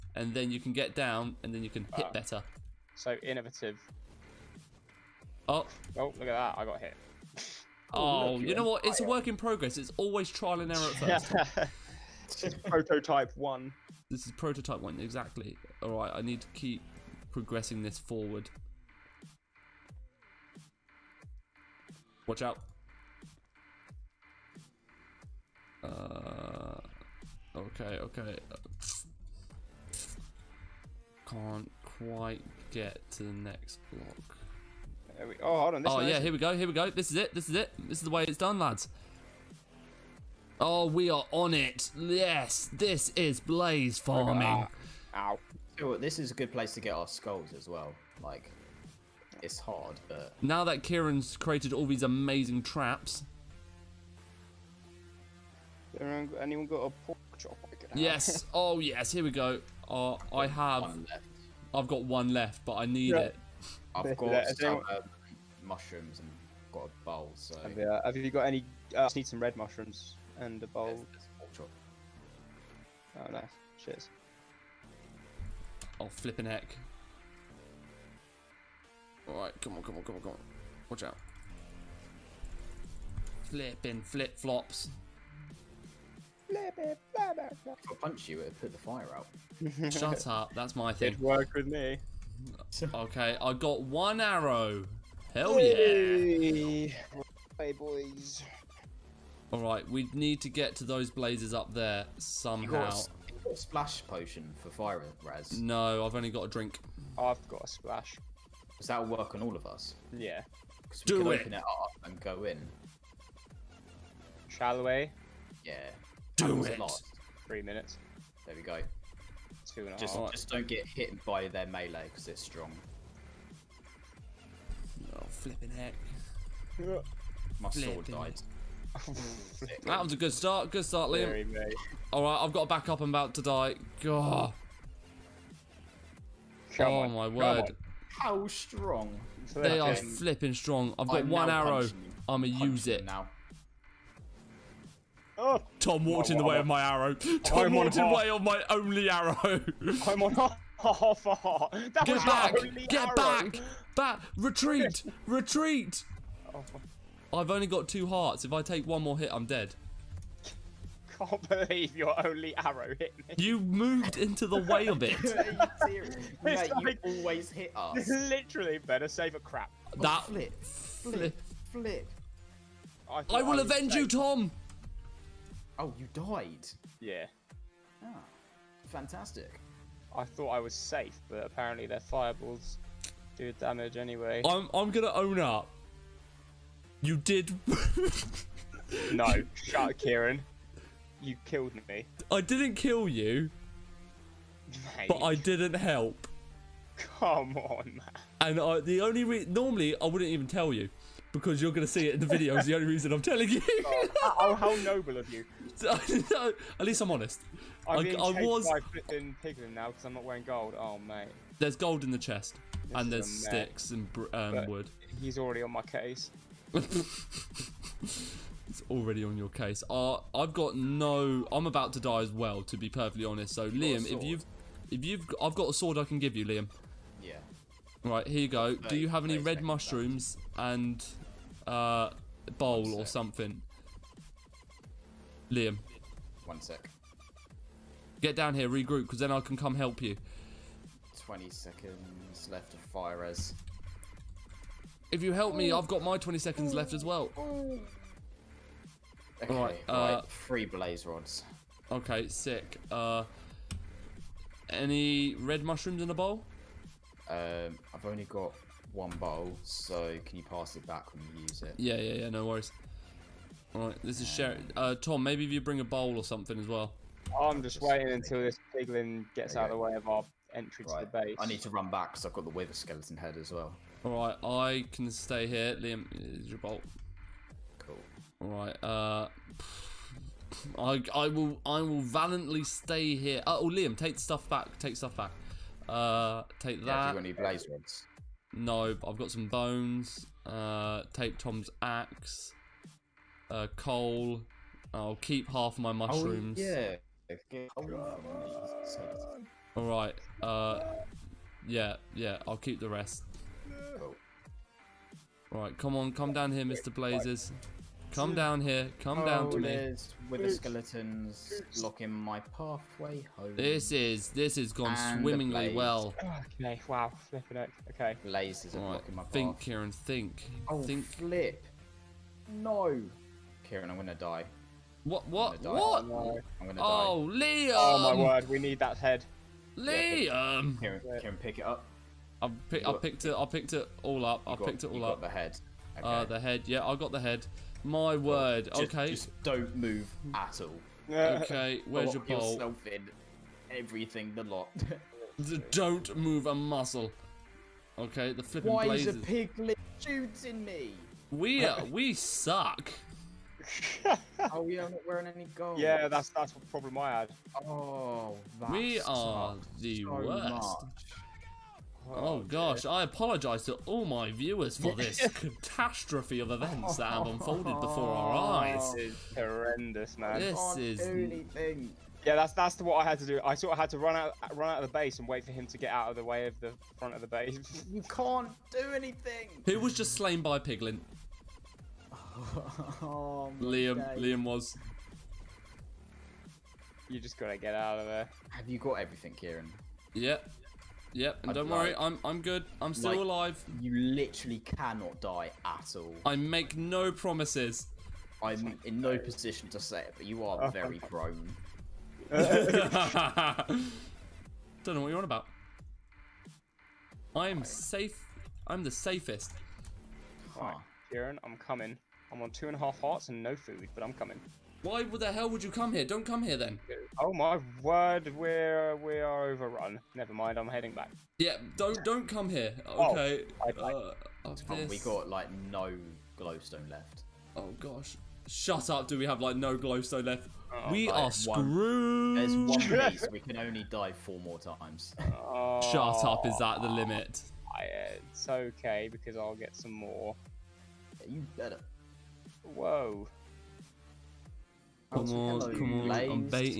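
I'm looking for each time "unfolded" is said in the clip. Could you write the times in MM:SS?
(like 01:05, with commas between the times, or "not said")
06:07.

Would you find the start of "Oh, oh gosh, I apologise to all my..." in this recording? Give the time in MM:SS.
06:02.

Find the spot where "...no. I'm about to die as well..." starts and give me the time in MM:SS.
03:40.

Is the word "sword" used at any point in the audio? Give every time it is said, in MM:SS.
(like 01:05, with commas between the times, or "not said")
02:07, 03:45.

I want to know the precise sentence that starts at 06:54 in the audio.
Why the hell would you come here?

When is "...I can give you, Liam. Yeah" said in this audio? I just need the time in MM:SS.
03:45.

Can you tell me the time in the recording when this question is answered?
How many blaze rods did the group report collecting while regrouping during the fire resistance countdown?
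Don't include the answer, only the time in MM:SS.
04:10.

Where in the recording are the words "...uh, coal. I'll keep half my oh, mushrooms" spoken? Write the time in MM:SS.
04:53.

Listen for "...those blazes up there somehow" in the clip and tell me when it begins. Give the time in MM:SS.
01:40.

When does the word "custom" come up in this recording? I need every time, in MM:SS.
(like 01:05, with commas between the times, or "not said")
not said.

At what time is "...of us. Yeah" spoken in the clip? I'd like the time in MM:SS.
01:49.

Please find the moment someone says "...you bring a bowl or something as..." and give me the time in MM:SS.
04:25.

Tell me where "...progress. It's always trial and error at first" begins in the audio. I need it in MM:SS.
00:09.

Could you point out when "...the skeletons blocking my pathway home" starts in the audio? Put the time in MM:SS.
05:10.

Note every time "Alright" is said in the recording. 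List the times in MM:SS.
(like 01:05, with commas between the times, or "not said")
04:23, 04:34, 04:38.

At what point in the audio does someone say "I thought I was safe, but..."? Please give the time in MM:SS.
03:00.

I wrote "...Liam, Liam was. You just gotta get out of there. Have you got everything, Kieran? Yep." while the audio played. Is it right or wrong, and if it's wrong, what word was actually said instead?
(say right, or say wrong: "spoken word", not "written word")
right.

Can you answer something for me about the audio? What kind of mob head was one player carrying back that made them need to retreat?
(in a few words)
Wither skeleton head.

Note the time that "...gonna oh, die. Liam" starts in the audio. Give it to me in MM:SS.
05:26.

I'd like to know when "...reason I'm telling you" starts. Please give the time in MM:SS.
03:22.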